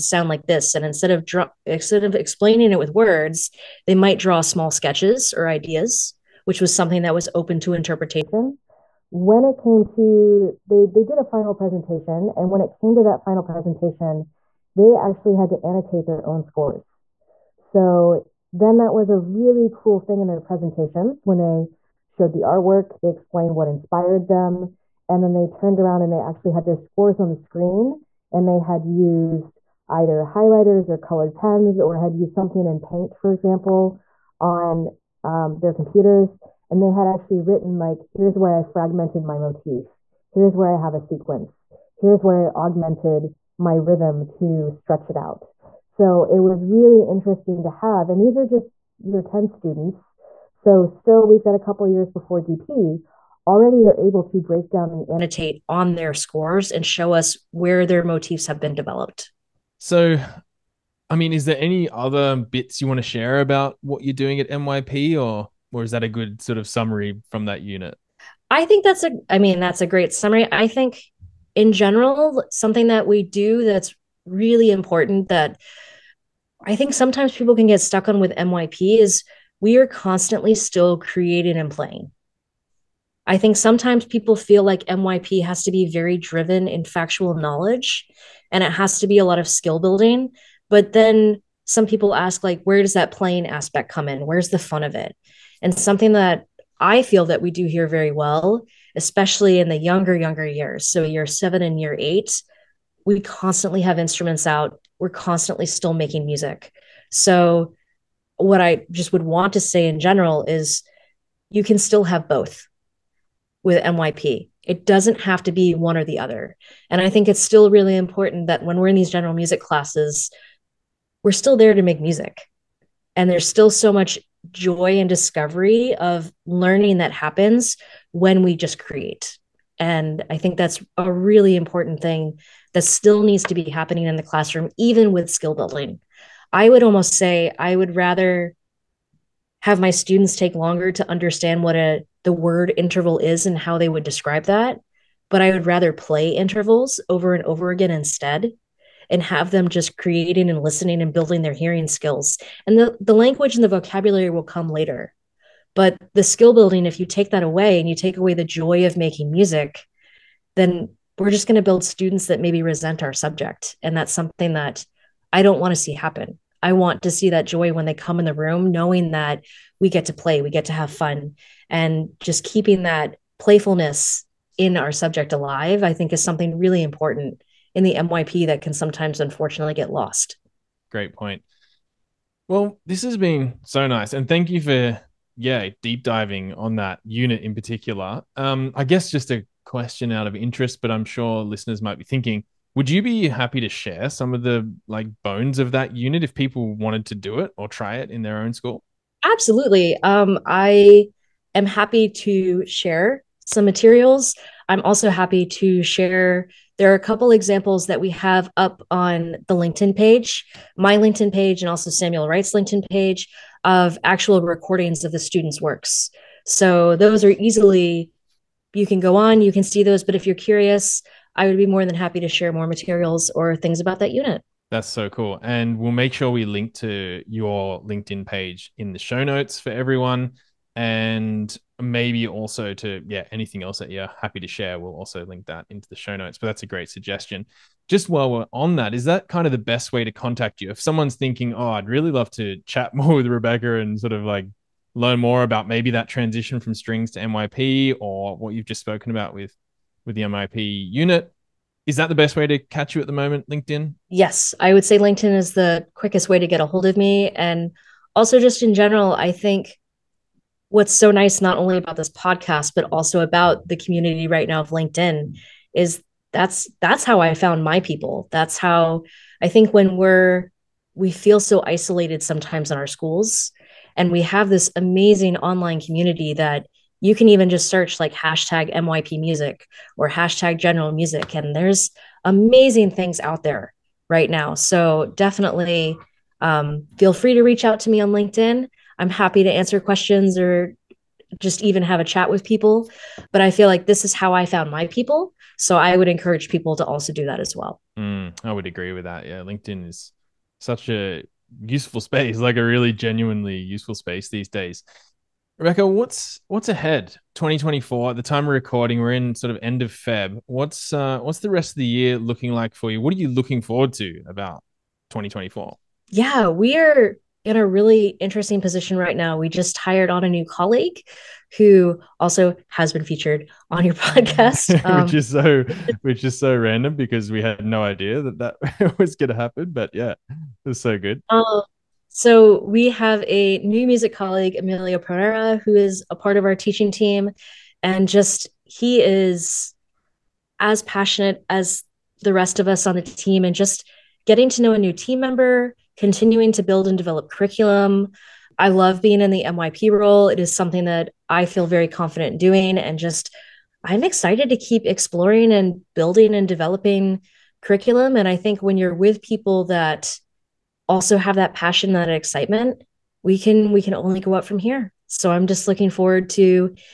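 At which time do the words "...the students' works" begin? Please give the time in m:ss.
3:35.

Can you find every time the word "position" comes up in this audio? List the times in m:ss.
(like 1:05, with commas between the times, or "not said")
5:18.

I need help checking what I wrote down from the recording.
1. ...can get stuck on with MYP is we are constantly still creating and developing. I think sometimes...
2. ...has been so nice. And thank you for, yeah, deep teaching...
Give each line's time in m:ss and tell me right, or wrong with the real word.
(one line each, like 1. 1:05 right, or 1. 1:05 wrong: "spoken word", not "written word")
1. 1:17 wrong: "playing", not "developing"
2. 3:03 wrong: "diving", not "teaching".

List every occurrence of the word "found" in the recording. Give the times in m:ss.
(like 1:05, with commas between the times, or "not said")
4:27, 4:54.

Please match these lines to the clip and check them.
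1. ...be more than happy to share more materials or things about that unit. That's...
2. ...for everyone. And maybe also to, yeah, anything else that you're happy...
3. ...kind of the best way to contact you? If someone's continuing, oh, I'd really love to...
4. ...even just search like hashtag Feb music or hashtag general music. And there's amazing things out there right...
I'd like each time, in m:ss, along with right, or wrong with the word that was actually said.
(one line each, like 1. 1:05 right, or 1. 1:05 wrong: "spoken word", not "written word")
1. 3:41 right
2. 3:49 right
3. 3:59 wrong: "thinking", not "continuing"
4. 4:37 wrong: "MYP", not "Feb".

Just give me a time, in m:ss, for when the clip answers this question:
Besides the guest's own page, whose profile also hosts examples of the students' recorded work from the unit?
3:31.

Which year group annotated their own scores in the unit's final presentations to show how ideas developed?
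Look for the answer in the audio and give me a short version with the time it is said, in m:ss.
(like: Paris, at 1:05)
Year 10, at 0:49.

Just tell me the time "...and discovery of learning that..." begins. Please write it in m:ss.
2:05.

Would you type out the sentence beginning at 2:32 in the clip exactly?
And the, the language and the vocabulary will come later.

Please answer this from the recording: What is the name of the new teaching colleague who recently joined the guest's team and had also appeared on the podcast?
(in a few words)
Emilio Pereira.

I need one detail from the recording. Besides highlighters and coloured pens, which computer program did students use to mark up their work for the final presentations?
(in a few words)
Paint.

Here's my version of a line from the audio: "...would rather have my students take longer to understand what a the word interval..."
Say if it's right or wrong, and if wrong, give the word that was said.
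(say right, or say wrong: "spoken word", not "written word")
right.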